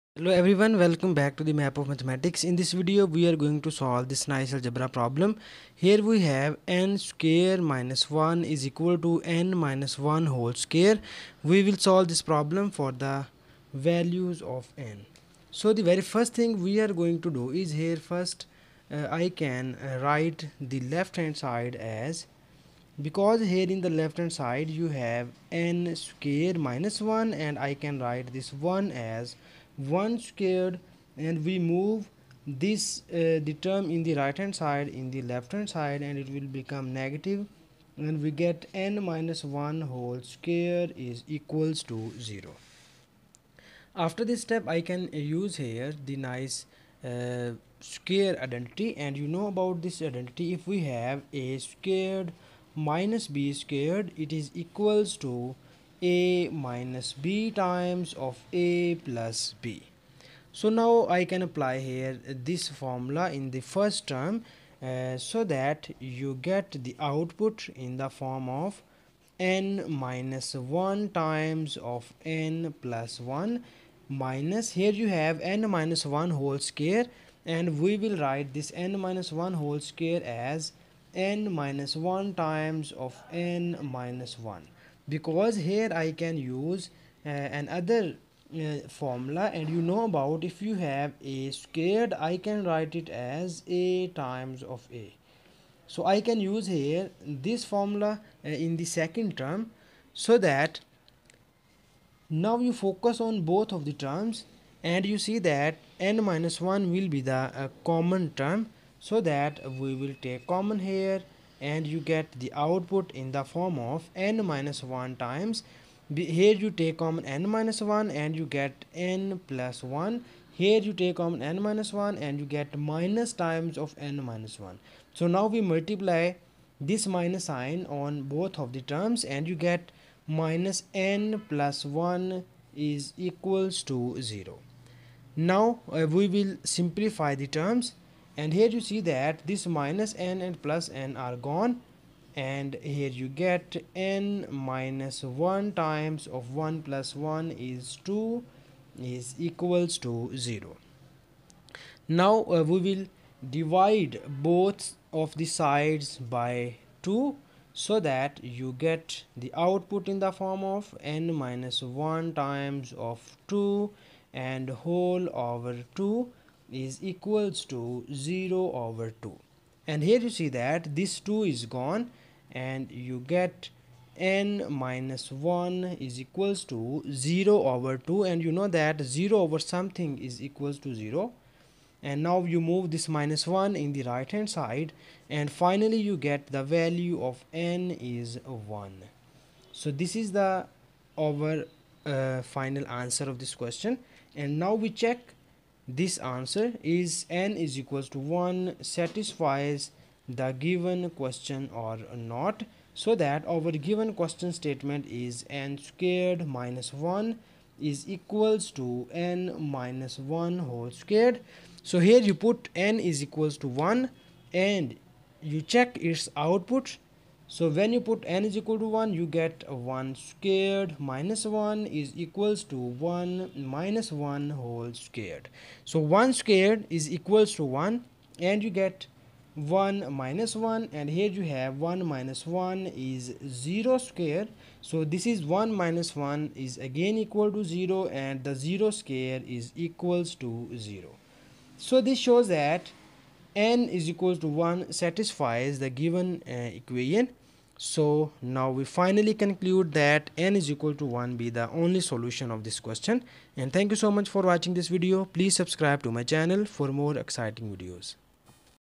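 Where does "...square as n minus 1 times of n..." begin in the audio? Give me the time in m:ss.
1:19.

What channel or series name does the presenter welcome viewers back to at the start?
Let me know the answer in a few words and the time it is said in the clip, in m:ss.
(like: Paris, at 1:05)
The Map of Mathematics, at 0:01.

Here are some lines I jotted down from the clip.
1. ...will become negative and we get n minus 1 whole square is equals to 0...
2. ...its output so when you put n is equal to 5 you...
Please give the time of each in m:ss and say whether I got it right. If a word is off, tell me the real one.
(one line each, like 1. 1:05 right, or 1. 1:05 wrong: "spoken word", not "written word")
1. 0:36 right
2. 3:35 wrong: "1", not "5".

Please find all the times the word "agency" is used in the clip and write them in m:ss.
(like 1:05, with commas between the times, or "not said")
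not said.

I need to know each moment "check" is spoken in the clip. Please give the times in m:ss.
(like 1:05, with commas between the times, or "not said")
3:14, 3:35.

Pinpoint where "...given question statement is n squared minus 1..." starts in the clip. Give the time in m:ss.
3:23.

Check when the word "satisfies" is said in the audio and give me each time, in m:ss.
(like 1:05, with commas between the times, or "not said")
3:18, 4:05.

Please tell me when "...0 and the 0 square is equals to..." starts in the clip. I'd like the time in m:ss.
3:57.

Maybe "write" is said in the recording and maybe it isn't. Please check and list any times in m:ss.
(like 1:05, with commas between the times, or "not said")
0:20, 0:28, 1:18, 1:32.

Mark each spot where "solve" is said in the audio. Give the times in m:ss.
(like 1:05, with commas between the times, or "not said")
0:03, 0:11.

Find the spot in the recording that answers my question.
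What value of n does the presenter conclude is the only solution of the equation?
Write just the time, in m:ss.
3:07.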